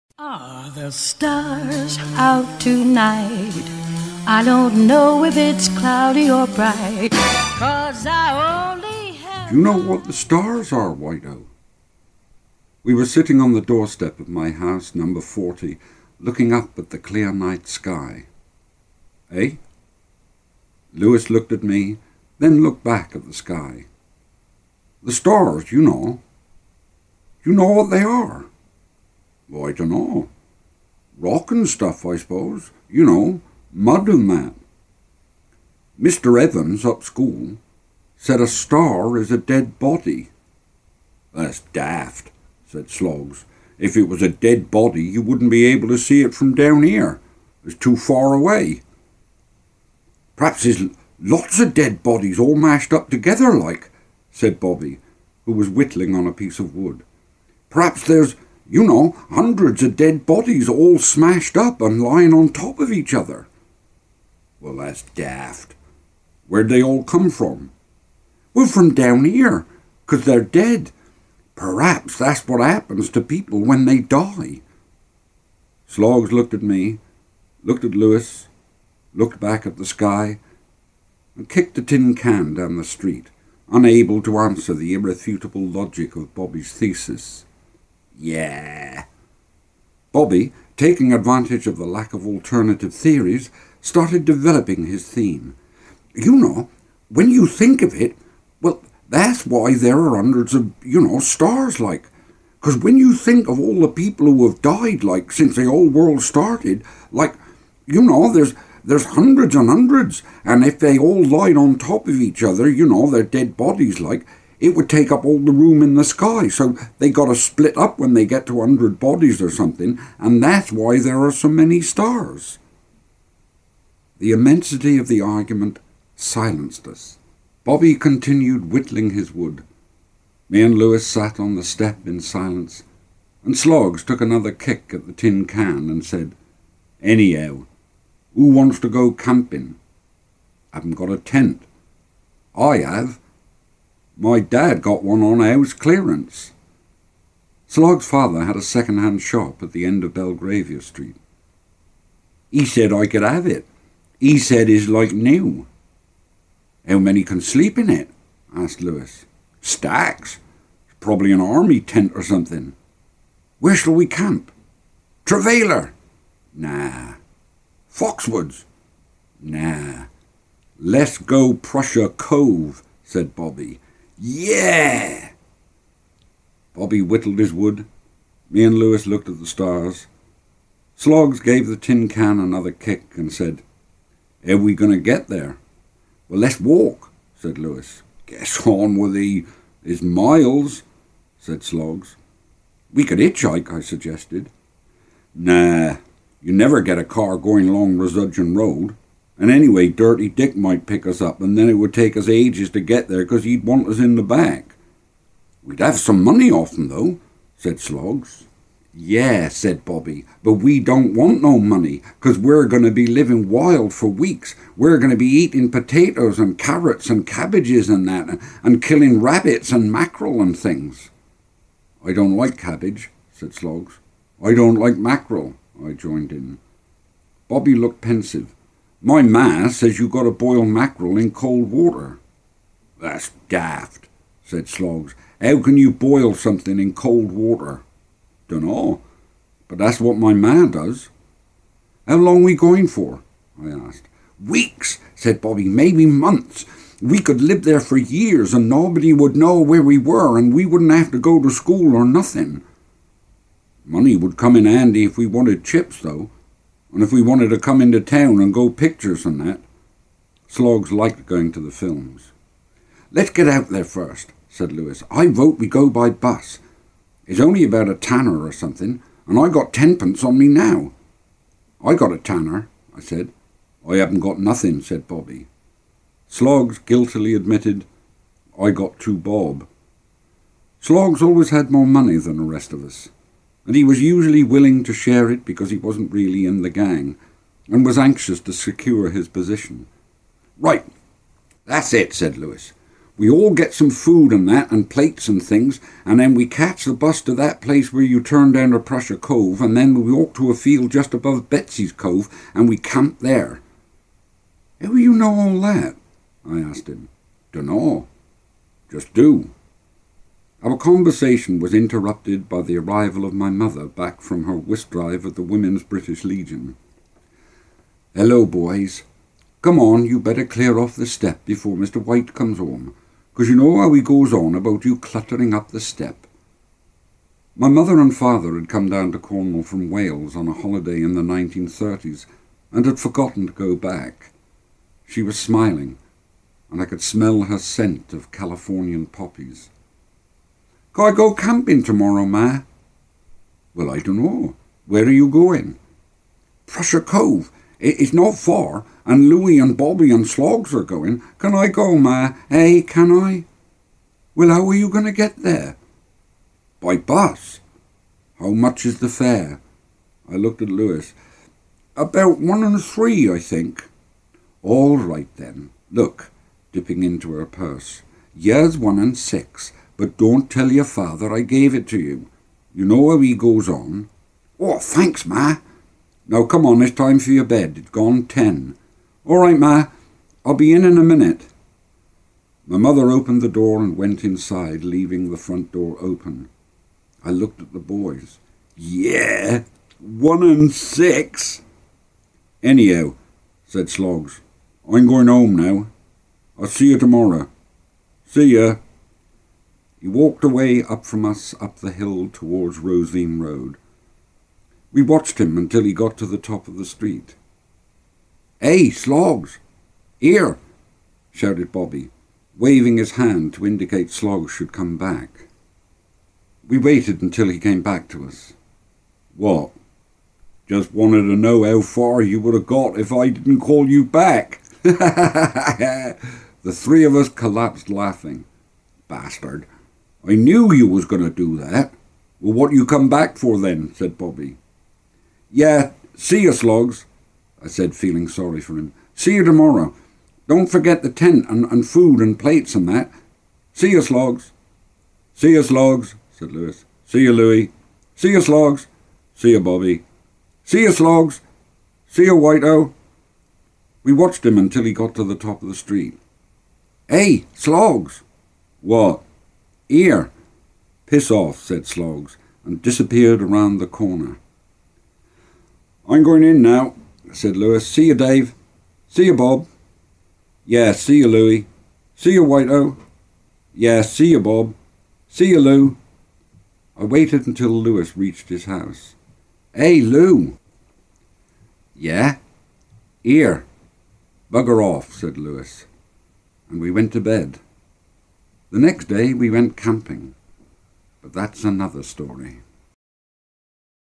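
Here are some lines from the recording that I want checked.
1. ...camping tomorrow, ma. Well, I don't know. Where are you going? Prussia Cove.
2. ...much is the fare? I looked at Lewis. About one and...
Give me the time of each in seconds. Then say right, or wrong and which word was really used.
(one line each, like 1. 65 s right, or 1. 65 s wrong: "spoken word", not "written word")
1. 341 s right
2. 358 s right.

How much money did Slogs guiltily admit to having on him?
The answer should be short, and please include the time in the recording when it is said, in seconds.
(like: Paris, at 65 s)
Two bob, at 278 s.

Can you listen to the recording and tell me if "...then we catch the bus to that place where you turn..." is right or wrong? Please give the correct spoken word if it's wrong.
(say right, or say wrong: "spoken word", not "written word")
right.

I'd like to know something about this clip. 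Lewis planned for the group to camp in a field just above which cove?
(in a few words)
Betsy's Cove.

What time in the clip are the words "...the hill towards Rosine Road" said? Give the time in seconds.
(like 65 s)
401 s.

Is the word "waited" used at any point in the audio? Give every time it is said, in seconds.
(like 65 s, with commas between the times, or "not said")
416 s, 477 s.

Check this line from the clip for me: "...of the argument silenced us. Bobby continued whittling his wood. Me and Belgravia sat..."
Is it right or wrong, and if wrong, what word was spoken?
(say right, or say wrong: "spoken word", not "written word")
wrong: "Lewis", not "Belgravia".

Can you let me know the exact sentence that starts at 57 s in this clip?
Perhaps there's you know, hundreds of dead bodies all smashed up and lying on top of each other.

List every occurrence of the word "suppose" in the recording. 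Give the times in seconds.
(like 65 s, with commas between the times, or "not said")
32 s.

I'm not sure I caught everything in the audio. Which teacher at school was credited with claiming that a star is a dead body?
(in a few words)
Mr. Evans.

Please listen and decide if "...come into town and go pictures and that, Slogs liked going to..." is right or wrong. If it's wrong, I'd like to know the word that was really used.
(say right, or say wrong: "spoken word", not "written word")
right.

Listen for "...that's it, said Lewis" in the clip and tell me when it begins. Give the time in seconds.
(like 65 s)
291 s.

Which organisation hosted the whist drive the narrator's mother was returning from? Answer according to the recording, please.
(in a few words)
Women's British Legion.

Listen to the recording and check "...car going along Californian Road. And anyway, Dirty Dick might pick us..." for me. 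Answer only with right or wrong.
wrong.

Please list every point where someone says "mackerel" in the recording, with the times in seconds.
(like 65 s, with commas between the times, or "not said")
219 s, 224 s, 230 s.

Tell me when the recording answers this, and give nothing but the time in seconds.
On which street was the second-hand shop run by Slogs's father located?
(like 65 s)
150 s.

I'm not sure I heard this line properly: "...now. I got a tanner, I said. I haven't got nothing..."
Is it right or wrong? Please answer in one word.
right.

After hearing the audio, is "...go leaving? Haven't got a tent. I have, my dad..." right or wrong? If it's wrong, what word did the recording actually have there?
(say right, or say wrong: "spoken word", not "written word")
wrong: "camping", not "leaving".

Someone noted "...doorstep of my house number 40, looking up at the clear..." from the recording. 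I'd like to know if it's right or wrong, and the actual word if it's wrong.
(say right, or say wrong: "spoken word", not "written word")
right.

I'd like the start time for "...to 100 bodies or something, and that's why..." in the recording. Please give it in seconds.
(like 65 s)
118 s.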